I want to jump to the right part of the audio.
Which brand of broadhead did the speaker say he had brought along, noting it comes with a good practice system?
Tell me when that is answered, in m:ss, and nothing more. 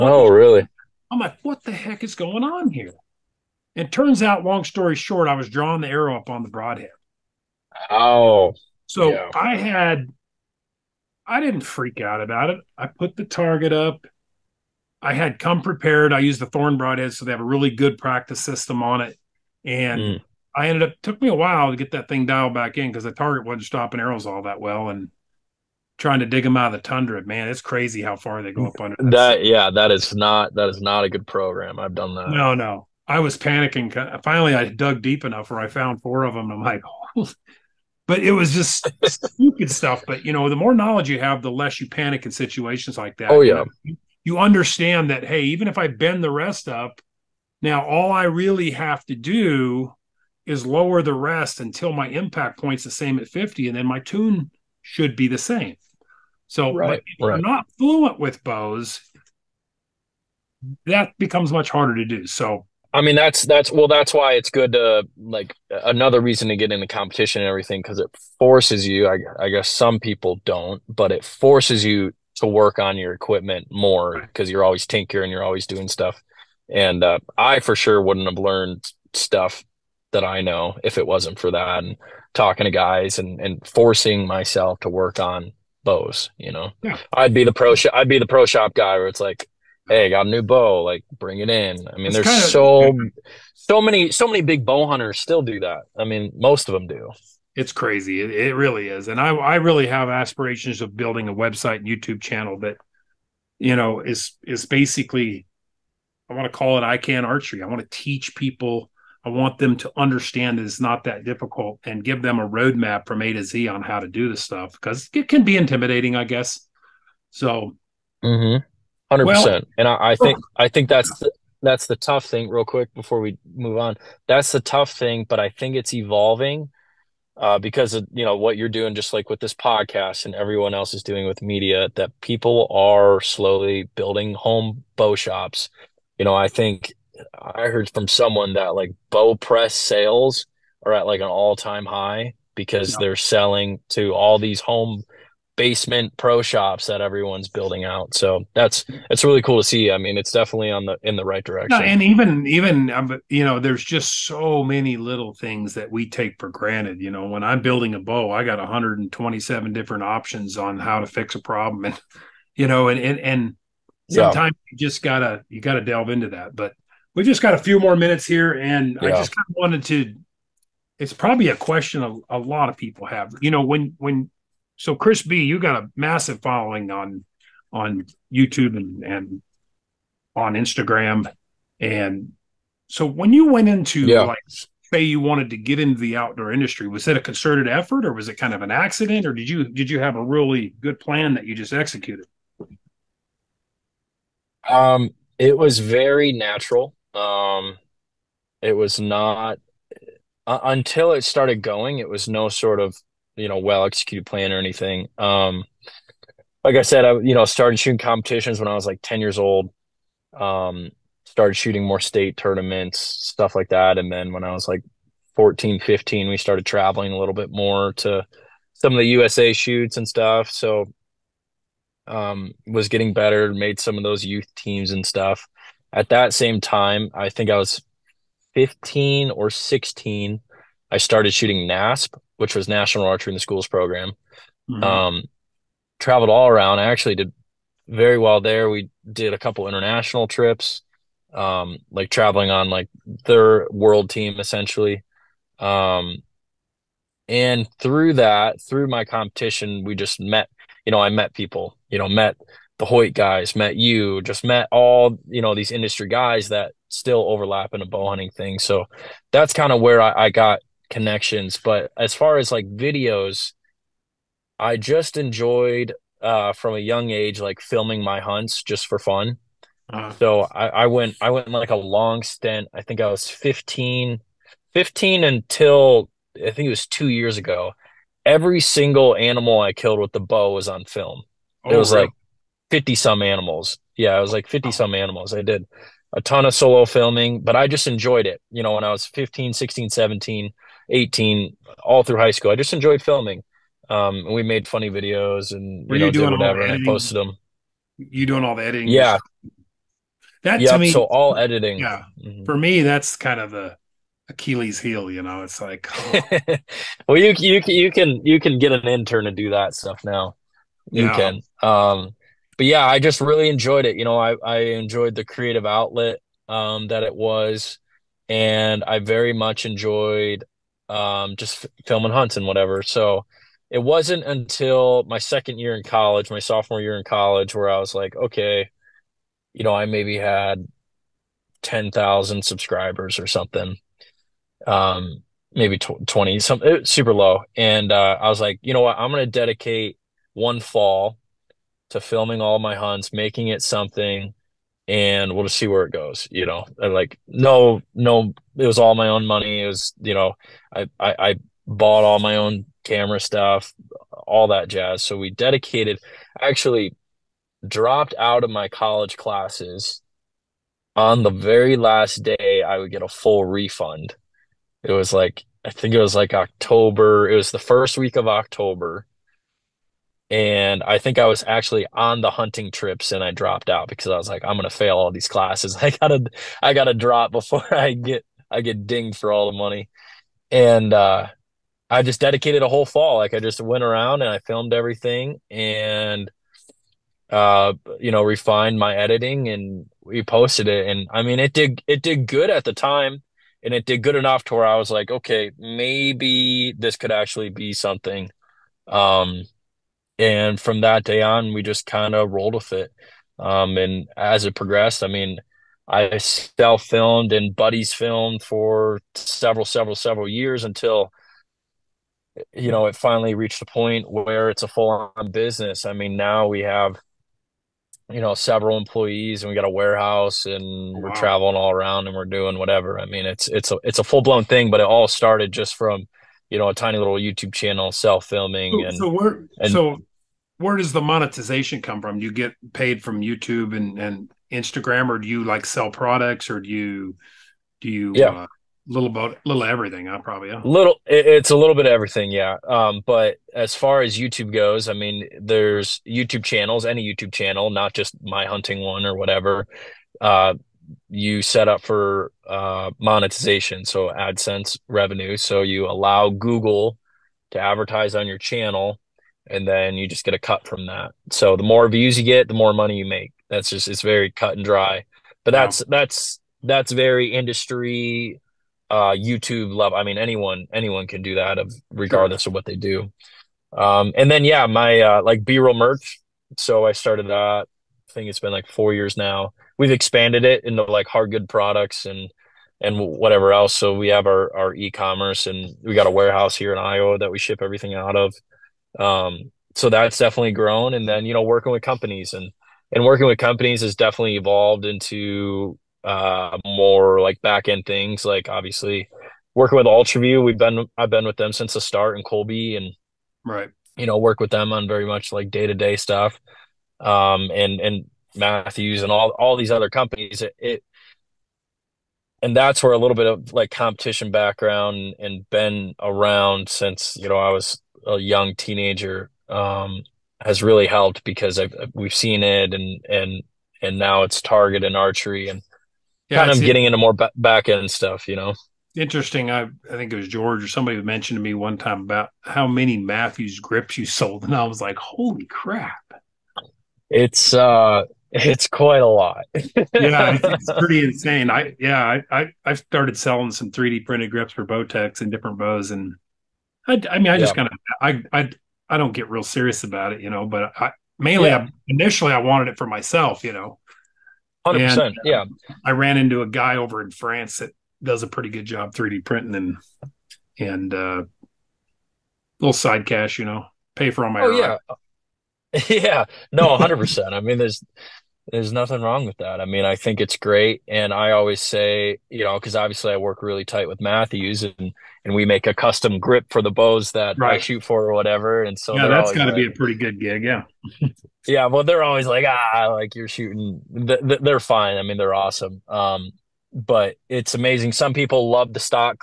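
0:16.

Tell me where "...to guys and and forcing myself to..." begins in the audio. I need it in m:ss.
1:22.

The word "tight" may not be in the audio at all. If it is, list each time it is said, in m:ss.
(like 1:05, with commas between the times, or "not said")
9:33.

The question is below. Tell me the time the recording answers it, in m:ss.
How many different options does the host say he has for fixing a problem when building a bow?
2:38.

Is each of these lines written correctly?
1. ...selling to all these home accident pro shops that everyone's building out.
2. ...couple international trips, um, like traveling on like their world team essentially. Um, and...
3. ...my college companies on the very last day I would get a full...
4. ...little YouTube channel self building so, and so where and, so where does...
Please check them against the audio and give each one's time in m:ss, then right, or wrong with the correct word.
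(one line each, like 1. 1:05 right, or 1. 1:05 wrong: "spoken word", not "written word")
1. 2:23 wrong: "basement", not "accident"
2. 3:59 right
3. 5:58 wrong: "classes", not "companies"
4. 7:06 wrong: "filming", not "building".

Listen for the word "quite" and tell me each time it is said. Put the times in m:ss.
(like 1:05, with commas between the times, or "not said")
8:58.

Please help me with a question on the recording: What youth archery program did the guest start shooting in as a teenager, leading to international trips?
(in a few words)
National Archery in the Schools.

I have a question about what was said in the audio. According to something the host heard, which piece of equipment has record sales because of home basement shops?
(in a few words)
Bow press.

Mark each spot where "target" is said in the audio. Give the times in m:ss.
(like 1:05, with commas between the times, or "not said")
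0:13, 0:23, 8:44.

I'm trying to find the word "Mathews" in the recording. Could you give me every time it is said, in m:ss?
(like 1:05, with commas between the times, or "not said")
8:28, 8:52, 9:34.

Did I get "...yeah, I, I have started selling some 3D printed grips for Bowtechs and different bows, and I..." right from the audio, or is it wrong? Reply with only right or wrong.
right.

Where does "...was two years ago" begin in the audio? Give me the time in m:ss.
4:36.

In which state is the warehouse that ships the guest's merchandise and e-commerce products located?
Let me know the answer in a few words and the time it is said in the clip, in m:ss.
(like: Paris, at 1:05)
Iowa, at 8:06.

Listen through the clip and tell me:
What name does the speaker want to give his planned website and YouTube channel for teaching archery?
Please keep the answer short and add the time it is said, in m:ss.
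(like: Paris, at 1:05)
I Can Archery, at 1:46.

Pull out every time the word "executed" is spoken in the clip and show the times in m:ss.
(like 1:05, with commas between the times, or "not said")
3:11, 3:23.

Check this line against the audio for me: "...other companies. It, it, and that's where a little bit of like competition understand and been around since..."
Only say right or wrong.
wrong.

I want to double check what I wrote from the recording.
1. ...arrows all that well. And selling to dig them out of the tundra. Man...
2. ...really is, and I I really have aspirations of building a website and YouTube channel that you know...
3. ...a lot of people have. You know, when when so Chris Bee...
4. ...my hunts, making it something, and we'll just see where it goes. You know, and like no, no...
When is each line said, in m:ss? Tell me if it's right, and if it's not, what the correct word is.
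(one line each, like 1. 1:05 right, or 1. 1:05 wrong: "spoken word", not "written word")
1. 0:24 wrong: "trying", not "selling"
2. 1:38 right
3. 2:52 right
4. 5:42 right.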